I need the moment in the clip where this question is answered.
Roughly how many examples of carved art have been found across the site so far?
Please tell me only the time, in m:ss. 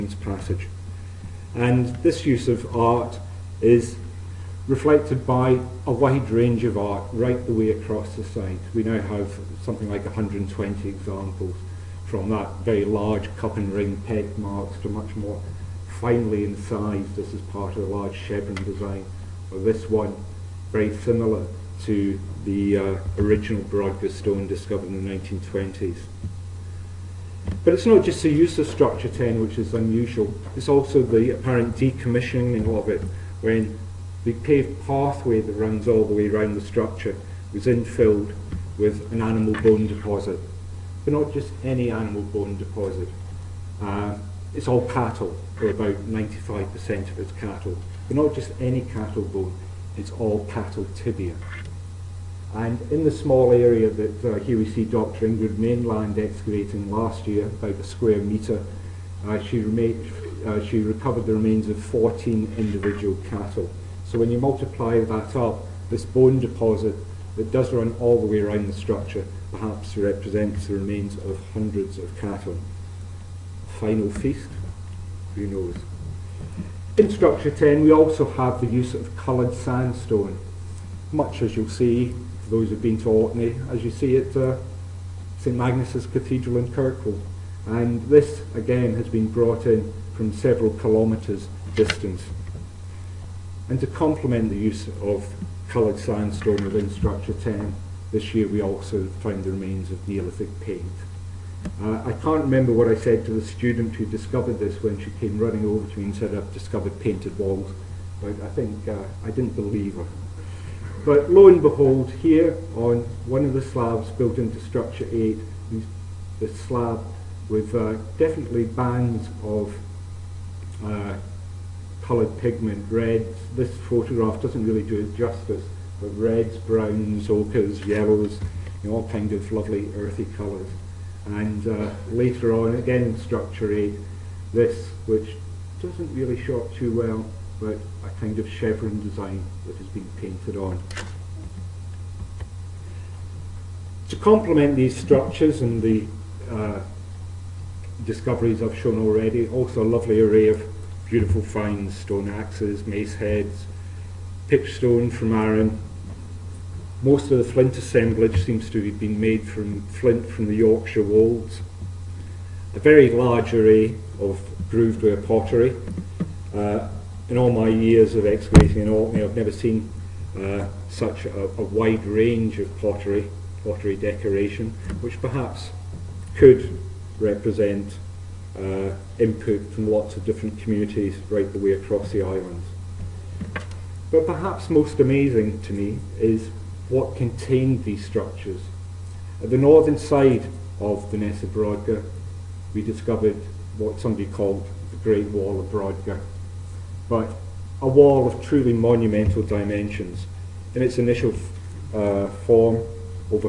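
0:10.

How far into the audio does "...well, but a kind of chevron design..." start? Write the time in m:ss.
2:16.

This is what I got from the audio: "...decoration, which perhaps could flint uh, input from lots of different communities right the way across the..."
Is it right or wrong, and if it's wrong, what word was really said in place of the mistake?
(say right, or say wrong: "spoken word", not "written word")
wrong: "represent", not "flint".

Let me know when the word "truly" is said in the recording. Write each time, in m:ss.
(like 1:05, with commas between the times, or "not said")
3:18.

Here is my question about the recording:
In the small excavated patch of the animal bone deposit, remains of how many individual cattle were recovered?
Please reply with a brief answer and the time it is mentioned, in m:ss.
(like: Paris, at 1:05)
14, at 1:01.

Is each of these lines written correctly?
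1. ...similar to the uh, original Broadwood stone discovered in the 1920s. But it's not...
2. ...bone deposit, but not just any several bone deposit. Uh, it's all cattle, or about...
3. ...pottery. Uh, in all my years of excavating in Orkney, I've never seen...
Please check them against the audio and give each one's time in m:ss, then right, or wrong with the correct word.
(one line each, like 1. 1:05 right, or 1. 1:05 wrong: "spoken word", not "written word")
1. 0:20 right
2. 0:39 wrong: "animal", not "several"
3. 2:45 right.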